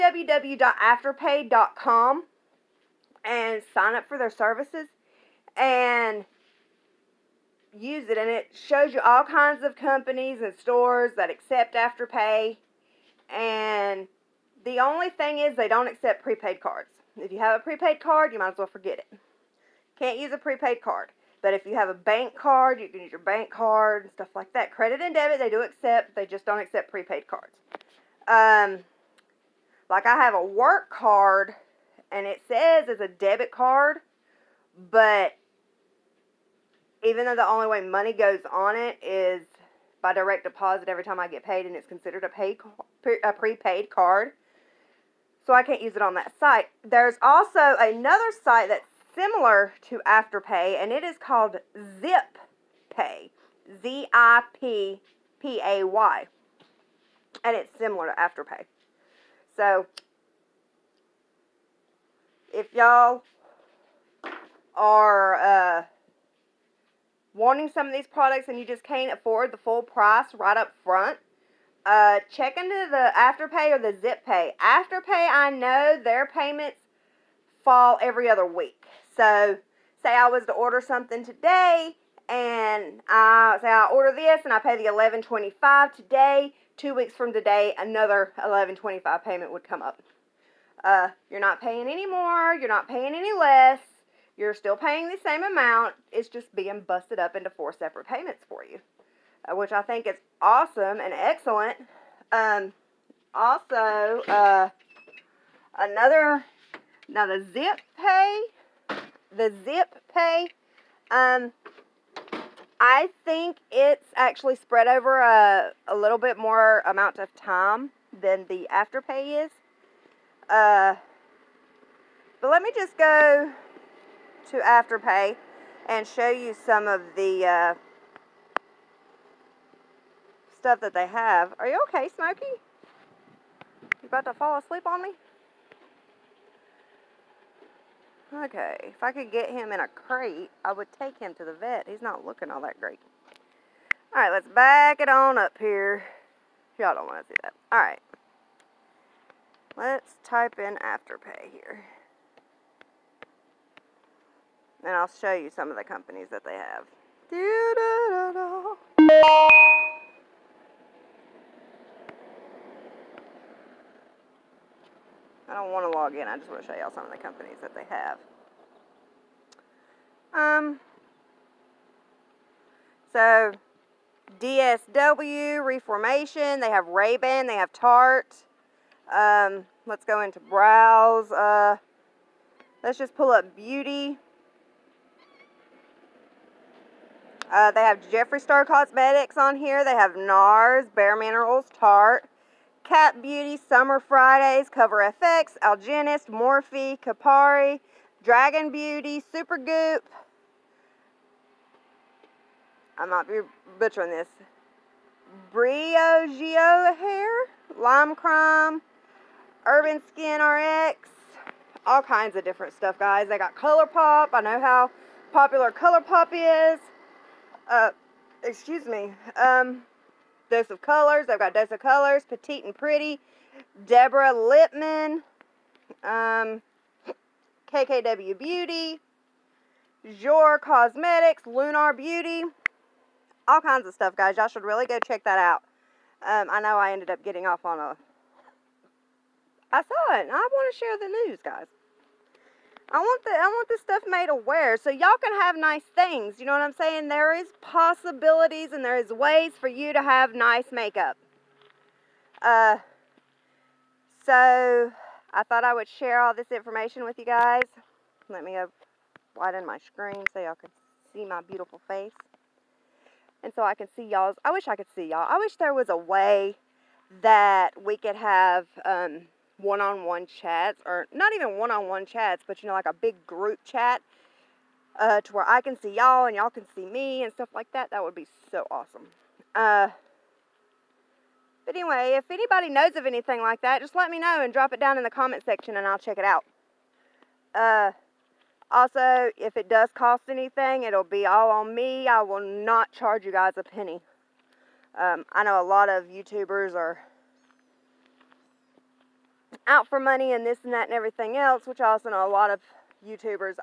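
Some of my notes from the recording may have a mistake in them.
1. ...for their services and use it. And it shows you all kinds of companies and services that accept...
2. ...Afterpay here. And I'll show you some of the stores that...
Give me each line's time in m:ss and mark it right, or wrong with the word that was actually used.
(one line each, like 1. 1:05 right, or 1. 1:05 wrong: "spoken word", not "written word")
1. 0:04 wrong: "stores", not "services"
2. 2:30 wrong: "companies", not "stores".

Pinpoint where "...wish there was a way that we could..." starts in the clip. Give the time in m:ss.
4:25.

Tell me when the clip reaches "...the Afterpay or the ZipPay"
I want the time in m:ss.
1:12.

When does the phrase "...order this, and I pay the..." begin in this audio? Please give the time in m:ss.
1:23.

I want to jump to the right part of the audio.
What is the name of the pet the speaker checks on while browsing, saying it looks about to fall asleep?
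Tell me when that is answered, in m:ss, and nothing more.
2:12.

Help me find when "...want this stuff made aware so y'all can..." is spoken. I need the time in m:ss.
4:03.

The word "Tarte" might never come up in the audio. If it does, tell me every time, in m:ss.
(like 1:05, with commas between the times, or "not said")
2:57, 3:11.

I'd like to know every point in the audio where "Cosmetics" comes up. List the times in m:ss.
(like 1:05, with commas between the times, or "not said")
3:08, 3:50.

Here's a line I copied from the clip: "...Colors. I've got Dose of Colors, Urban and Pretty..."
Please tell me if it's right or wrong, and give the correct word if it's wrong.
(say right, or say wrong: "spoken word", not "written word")
wrong: "Petite", not "Urban".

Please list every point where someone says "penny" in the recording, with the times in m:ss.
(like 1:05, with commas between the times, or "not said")
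4:53.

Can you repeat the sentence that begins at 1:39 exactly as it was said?
Uh, which I think is awesome and excellent.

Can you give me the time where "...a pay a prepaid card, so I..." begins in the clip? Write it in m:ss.
0:42.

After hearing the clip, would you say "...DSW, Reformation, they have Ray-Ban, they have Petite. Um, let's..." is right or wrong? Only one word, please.
wrong.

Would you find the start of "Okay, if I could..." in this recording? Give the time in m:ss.
2:18.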